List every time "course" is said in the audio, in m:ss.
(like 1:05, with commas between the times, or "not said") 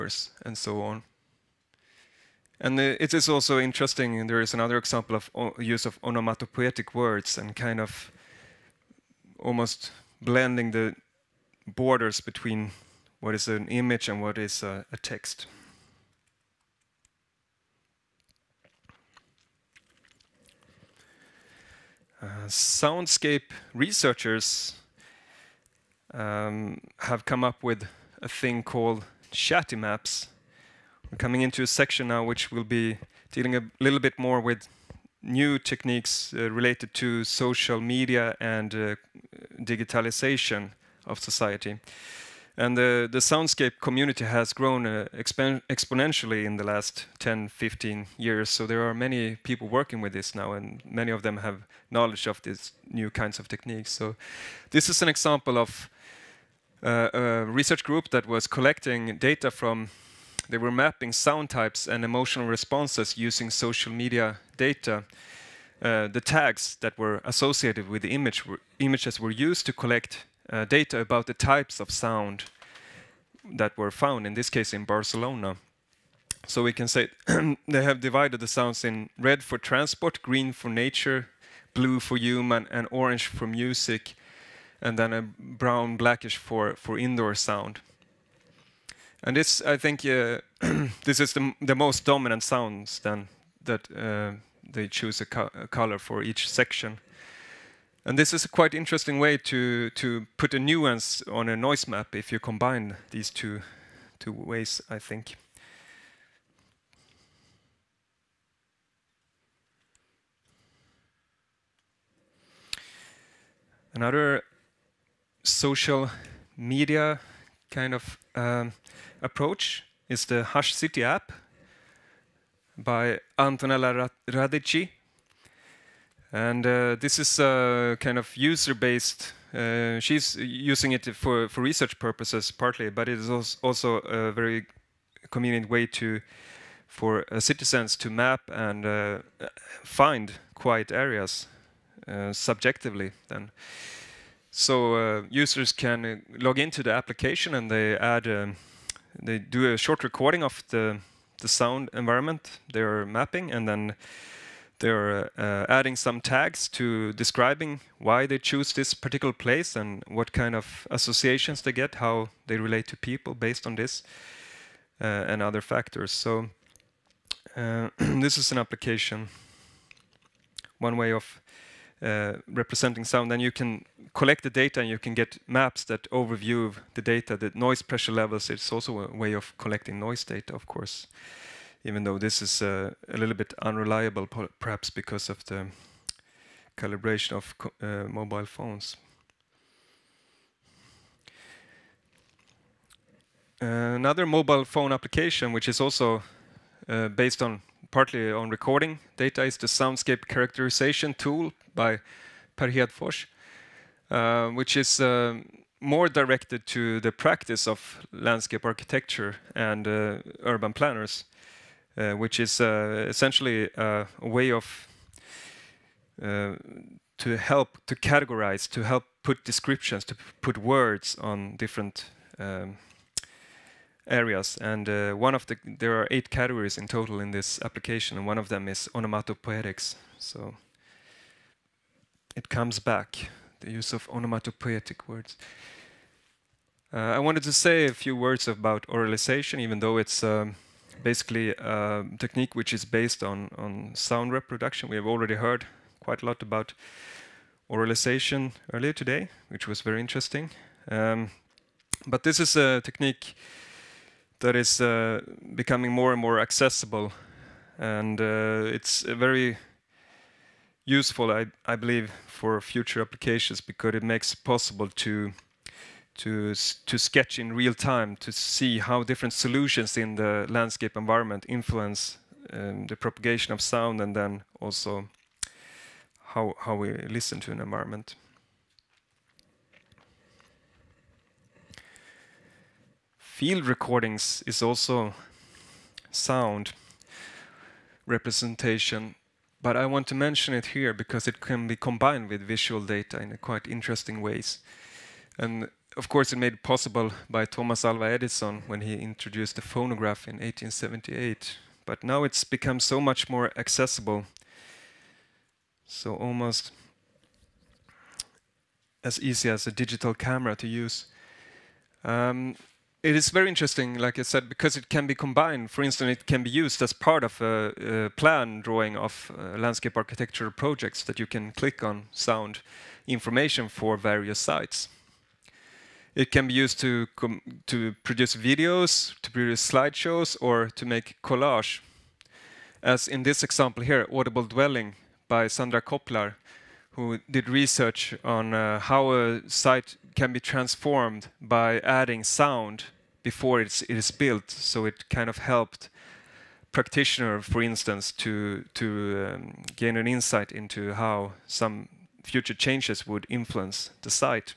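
3:00, 4:56.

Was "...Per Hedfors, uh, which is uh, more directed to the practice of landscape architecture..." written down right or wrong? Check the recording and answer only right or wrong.
right.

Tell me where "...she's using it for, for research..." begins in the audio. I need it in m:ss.
2:09.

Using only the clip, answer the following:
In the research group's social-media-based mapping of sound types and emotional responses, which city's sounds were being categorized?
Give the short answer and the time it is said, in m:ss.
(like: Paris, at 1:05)
Barcelona, at 1:14.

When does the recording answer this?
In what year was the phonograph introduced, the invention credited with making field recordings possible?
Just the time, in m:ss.
5:00.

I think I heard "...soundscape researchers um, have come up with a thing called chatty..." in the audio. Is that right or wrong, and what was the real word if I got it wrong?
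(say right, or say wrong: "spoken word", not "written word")
right.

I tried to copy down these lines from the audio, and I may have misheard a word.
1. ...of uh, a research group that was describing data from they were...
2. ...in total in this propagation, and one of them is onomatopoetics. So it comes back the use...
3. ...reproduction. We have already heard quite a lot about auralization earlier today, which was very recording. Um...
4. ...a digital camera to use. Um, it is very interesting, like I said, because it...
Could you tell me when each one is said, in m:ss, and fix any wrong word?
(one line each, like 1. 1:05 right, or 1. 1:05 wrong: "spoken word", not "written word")
1. 0:55 wrong: "collecting", not "describing"
2. 3:46 wrong: "application", not "propagation"
3. 4:04 wrong: "interesting", not "recording"
4. 5:09 right.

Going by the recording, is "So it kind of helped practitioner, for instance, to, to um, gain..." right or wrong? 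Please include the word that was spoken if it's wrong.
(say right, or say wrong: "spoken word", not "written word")
right.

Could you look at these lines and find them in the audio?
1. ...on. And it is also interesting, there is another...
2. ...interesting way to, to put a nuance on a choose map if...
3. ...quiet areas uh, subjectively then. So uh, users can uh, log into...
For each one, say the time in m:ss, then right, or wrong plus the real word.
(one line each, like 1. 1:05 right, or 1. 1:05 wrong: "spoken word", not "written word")
1. 0:00 right
2. 1:38 wrong: "noise", not "choose"
3. 2:20 right.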